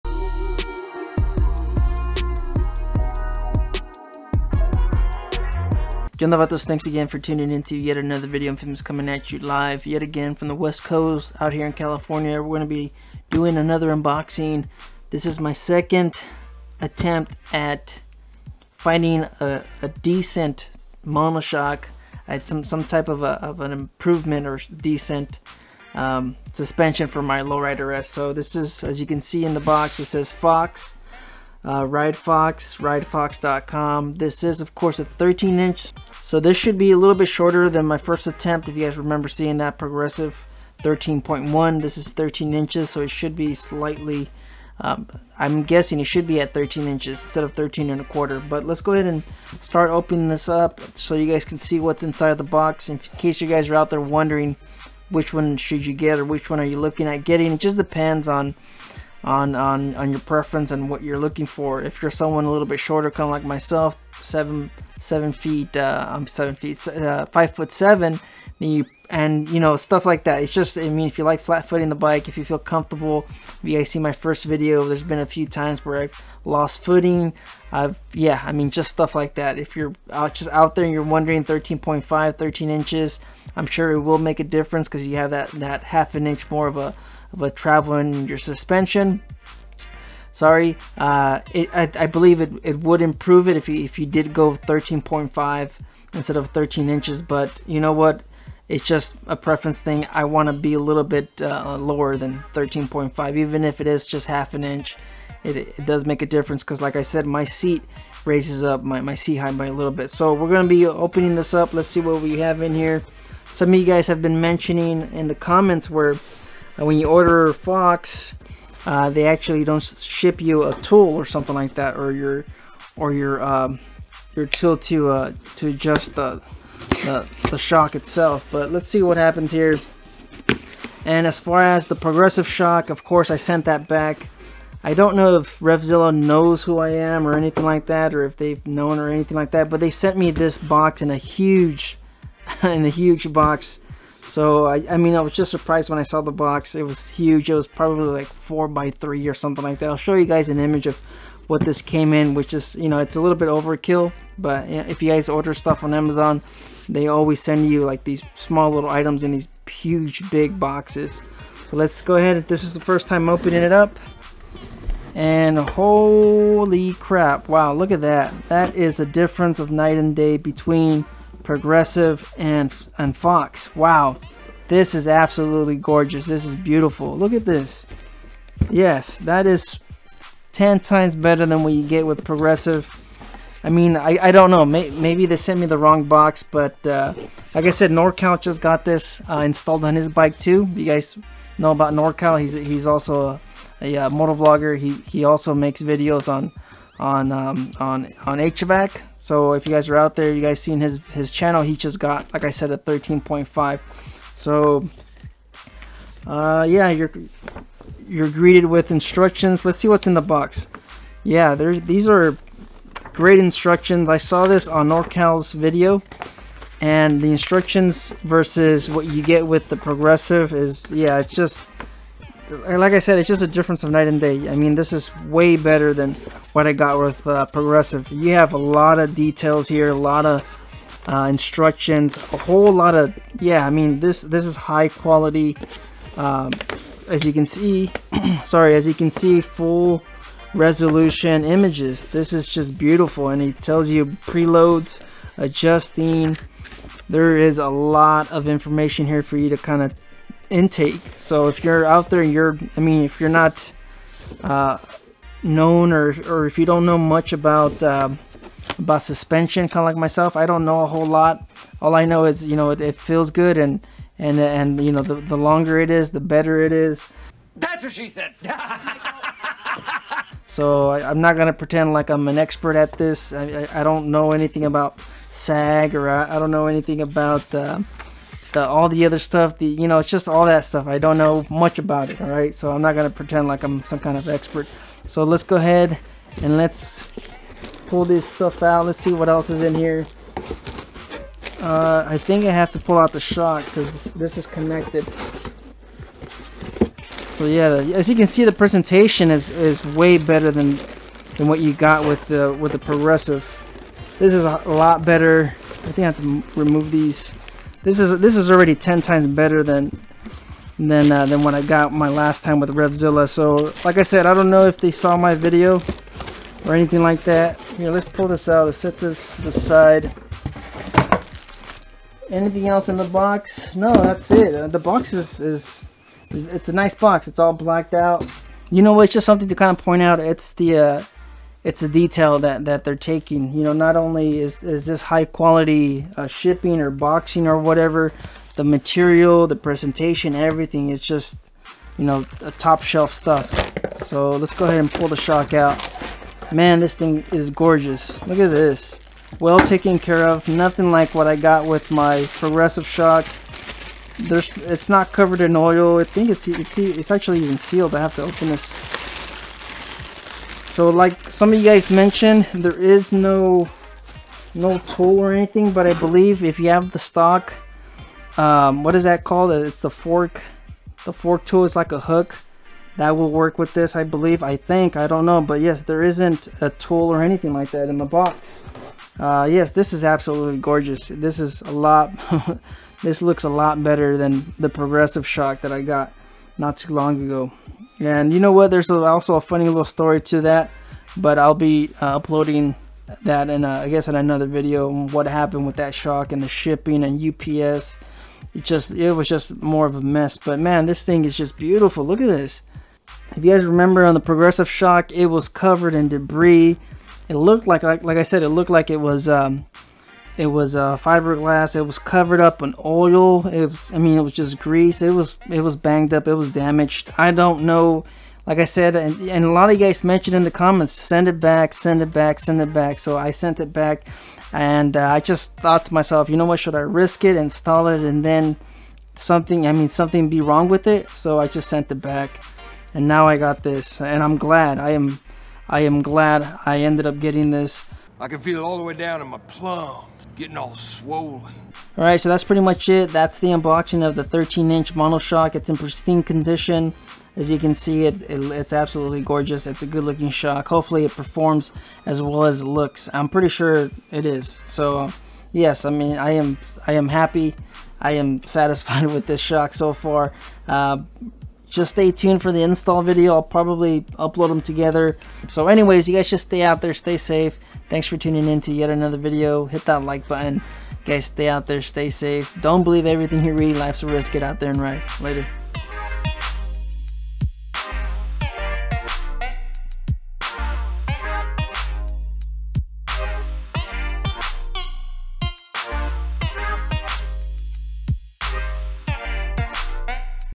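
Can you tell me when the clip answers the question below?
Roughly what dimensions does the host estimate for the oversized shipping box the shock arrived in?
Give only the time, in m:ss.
2:28.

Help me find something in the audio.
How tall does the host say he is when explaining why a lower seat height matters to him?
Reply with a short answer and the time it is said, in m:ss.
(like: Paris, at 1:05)
five foot seven, at 1:07.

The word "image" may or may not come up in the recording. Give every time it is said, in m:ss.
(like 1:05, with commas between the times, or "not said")
2:30, 4:01.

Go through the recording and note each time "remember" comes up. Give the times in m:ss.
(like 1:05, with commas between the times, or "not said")
0:38, 6:43.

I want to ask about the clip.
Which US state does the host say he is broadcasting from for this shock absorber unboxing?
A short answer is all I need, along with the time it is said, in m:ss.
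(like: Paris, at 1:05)
California, at 0:11.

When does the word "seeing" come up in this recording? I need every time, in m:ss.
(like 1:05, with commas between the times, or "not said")
0:39.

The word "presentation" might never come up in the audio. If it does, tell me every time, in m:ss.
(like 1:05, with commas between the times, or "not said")
4:58, 5:39.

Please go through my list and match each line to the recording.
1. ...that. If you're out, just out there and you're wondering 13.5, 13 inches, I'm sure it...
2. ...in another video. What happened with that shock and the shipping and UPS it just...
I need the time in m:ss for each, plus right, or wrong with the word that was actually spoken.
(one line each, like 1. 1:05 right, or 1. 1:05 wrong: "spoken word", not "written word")
1. 1:19 right
2. 6:34 right.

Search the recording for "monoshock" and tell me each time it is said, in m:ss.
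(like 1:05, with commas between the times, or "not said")
0:21, 7:24.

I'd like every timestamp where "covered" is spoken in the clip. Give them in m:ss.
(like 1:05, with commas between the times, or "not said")
5:55, 6:45, 6:51.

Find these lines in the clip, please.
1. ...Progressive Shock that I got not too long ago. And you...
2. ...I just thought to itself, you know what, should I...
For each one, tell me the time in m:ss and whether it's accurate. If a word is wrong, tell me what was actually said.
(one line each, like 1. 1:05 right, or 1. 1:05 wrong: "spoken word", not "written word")
1. 6:24 right
2. 7:05 wrong: "myself", not "itself".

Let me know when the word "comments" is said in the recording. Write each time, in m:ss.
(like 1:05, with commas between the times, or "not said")
1:55, 7:00.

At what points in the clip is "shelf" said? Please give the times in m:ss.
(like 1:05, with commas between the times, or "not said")
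5:42.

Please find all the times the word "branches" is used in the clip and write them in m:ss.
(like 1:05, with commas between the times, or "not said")
not said.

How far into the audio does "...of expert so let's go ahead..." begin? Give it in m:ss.
4:44.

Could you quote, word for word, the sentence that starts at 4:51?
Uh, I think I have to pull out the shock because this, this is connected.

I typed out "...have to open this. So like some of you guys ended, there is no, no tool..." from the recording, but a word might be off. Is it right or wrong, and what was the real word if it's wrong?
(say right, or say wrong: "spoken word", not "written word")
wrong: "mentioned", not "ended".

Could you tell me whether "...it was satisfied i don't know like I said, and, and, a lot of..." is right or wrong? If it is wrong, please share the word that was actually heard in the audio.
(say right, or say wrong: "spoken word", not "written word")
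wrong: "damaged", not "satisfied".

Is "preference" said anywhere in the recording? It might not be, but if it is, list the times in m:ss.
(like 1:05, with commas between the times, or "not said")
1:00, 1:39.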